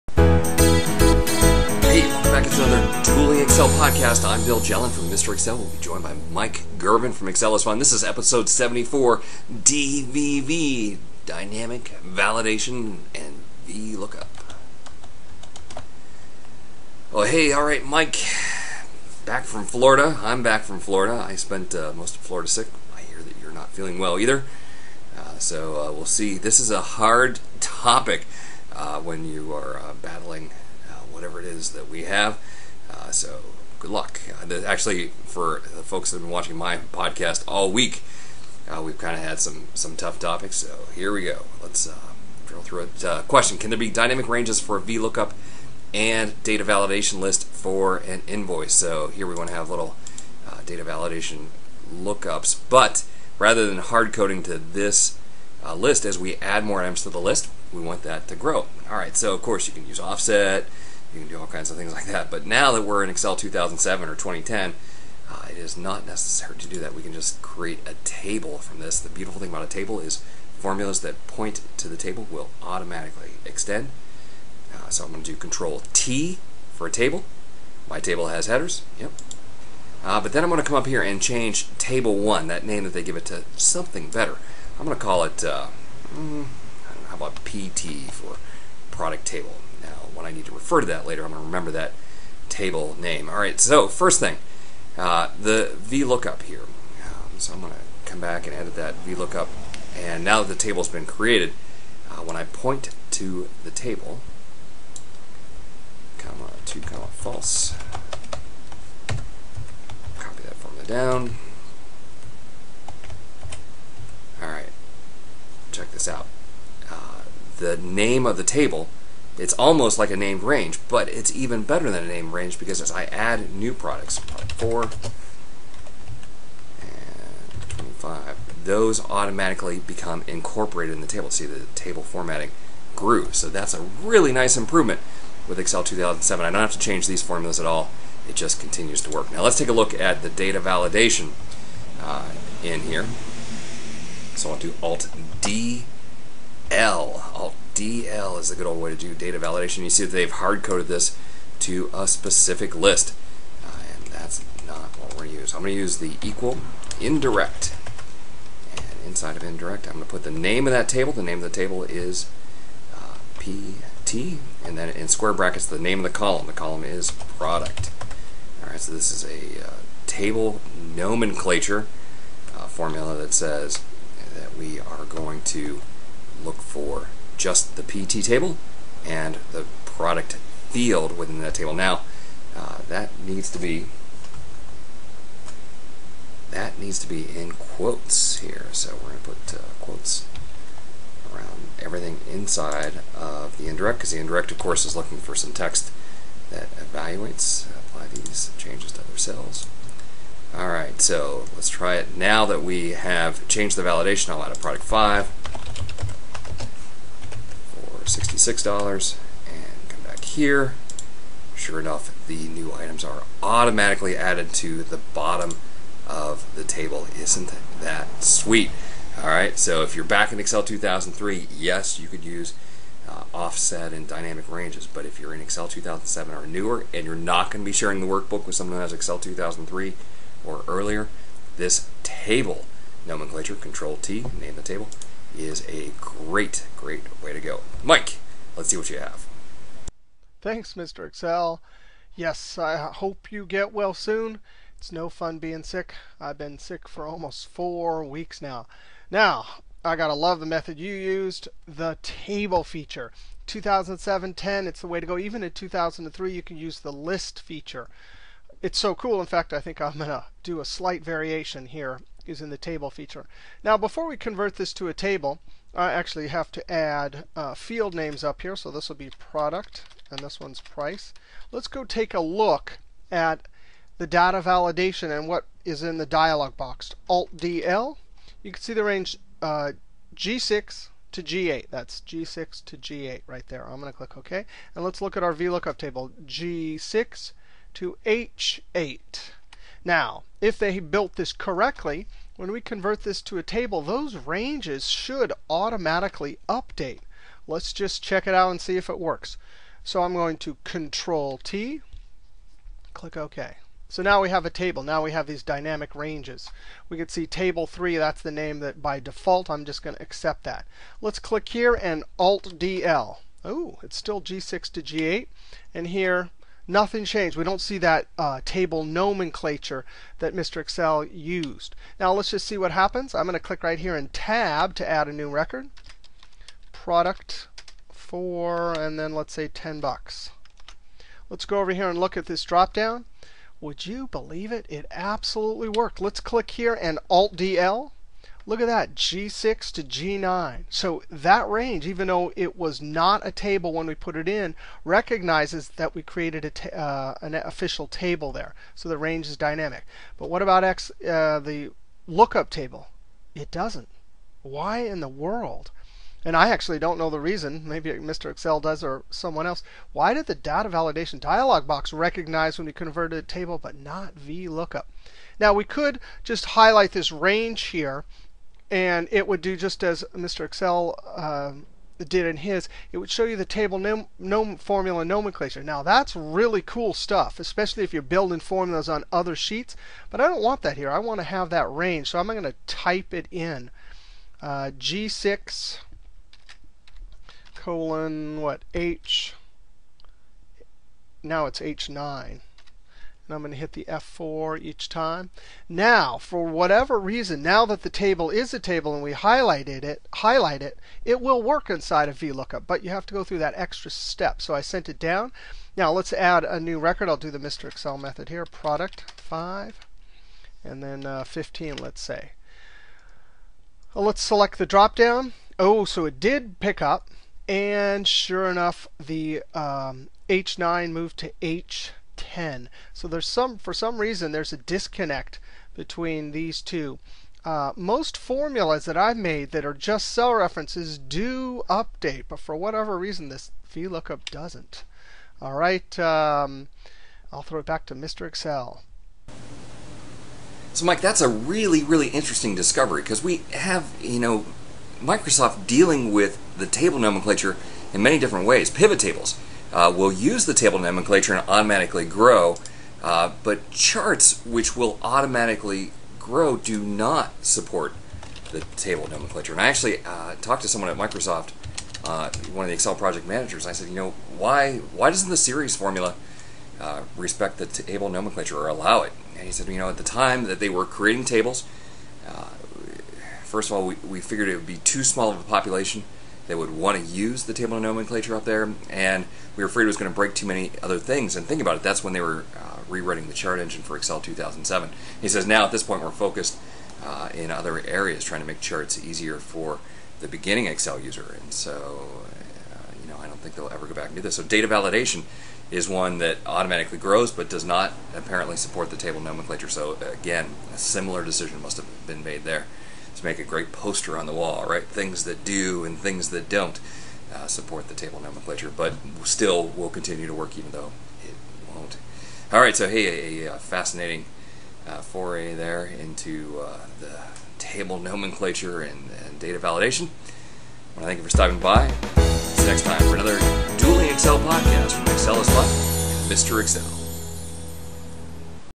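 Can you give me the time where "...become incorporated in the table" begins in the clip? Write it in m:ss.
2:09.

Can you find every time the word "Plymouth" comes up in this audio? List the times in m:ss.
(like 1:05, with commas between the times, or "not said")
not said.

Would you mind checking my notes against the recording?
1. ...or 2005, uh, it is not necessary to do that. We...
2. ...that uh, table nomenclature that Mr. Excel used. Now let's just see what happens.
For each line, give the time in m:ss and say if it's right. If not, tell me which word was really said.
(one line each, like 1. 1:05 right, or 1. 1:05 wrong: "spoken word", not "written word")
1. 1:04 wrong: "2010", not "2005"
2. 5:17 right.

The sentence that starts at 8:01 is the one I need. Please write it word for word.
And think about it, that's when they were uh, rewriting the chart engine for Excel 2007.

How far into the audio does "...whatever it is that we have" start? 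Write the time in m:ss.
0:31.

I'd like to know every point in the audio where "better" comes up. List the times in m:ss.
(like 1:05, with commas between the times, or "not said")
1:24, 2:01.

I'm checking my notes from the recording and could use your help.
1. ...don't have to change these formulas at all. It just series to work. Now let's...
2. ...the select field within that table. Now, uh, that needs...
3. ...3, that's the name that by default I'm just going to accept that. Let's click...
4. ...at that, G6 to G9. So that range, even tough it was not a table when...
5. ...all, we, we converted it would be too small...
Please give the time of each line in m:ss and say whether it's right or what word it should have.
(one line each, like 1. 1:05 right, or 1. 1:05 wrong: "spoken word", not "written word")
1. 2:16 wrong: "continues", not "series"
2. 2:59 wrong: "product", not "select"
3. 5:07 right
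4. 5:38 wrong: "though", not "tough"
5. 7:53 wrong: "figured", not "converted".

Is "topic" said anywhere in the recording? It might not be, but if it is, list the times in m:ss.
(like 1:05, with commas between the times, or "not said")
0:27, 0:40.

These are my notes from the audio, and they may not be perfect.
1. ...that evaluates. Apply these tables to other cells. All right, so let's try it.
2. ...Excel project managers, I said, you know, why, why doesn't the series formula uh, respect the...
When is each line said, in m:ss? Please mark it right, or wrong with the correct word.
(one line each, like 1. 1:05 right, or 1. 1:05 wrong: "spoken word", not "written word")
1. 3:16 wrong: "changes", not "tables"
2. 7:42 right.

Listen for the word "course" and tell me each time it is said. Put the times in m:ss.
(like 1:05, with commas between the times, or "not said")
0:59, 3:14.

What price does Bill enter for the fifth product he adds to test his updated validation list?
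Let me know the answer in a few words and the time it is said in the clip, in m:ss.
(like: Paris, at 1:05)
$66, at 3:28.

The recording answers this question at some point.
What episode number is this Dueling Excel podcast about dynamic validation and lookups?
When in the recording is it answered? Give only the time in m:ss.
0:08.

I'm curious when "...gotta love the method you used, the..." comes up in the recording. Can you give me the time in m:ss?
4:09.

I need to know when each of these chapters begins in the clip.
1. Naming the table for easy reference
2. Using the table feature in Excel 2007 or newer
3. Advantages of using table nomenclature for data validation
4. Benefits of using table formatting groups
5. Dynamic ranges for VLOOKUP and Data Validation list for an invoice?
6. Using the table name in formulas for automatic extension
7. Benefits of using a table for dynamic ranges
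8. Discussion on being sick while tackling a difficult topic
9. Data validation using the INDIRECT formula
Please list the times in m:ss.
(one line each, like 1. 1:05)
1. 1:17
2. 0:51
3. 3:02
4. 2:11
5. 0:41
6. 1:33
7. 1:07
8. 0:14
9. 2:21.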